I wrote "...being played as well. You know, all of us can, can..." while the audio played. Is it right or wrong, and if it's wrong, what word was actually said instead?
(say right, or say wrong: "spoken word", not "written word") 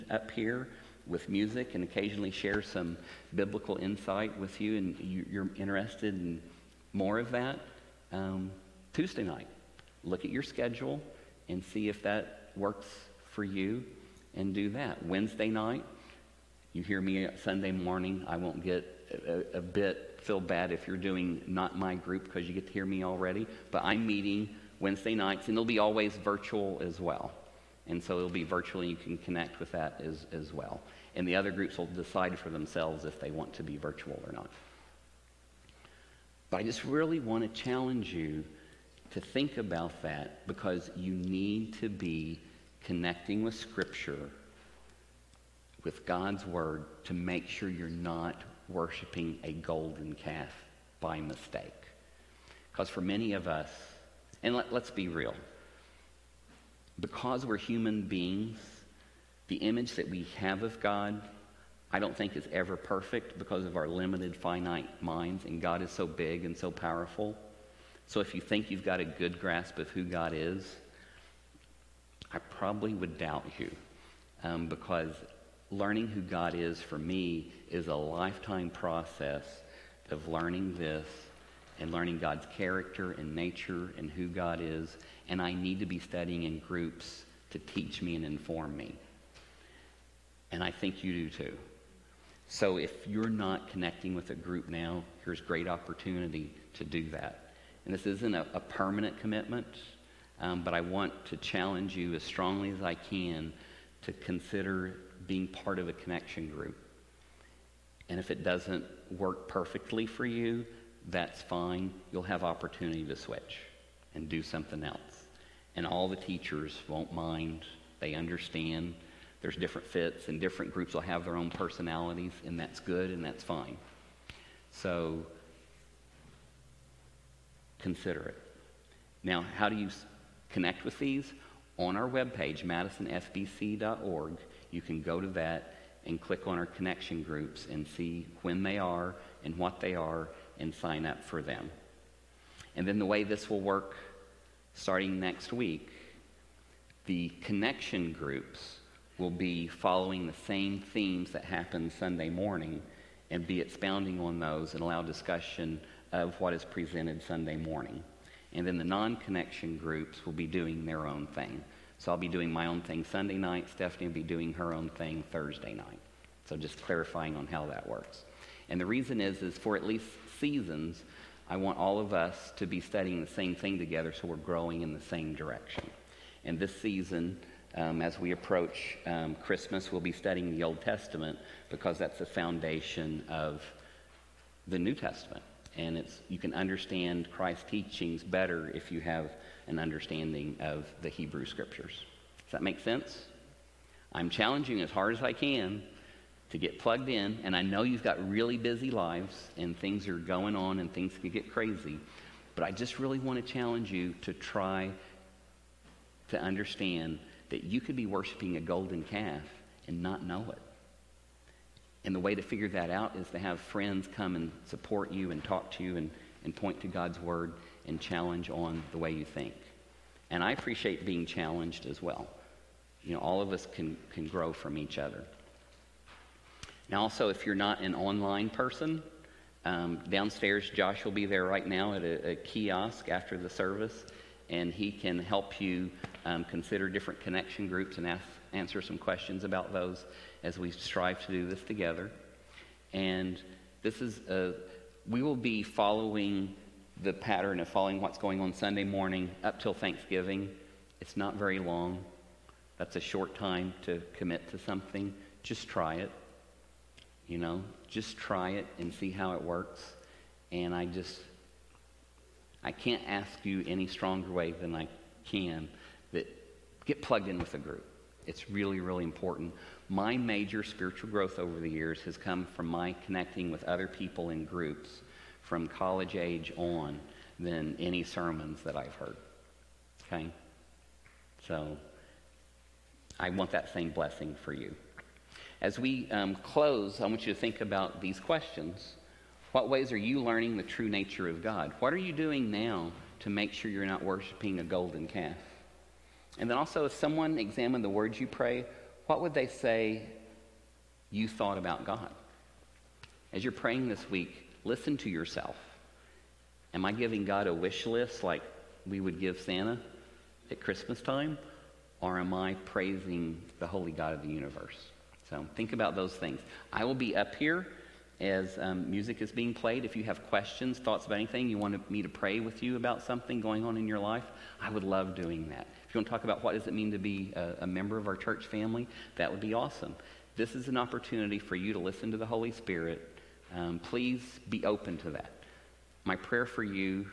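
wrong: "challenged", not "played".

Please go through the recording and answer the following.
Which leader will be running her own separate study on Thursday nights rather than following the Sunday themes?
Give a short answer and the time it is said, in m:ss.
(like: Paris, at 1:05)
Stephanie, at 2:43.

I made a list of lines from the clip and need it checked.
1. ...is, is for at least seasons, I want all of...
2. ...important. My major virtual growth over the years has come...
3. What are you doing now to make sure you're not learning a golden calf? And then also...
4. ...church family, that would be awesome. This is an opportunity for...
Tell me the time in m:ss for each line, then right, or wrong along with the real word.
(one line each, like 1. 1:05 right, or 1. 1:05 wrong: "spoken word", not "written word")
1. 2:49 right
2. 4:29 wrong: "spiritual", not "virtual"
3. 4:51 wrong: "worshiping", not "learning"
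4. 5:28 right.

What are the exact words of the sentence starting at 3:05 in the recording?
And it's, you can understand Christ's teachings better if you have an understanding of the Hebrew Scriptures.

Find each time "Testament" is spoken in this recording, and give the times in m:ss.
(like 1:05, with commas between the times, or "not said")
3:00, 3:04.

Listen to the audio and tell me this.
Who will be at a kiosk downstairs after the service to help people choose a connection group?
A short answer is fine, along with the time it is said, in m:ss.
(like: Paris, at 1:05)
Josh, at 3:50.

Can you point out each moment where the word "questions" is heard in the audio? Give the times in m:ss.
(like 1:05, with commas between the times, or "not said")
3:58, 4:48, 5:20.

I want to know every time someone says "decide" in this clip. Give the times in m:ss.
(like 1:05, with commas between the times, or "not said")
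0:31.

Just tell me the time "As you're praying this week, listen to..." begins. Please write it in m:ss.
5:03.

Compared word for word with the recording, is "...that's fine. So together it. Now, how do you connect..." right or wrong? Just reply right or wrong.
wrong.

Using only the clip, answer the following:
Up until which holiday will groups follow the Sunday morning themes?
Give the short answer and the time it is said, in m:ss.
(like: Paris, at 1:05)
Thanksgiving, at 4:09.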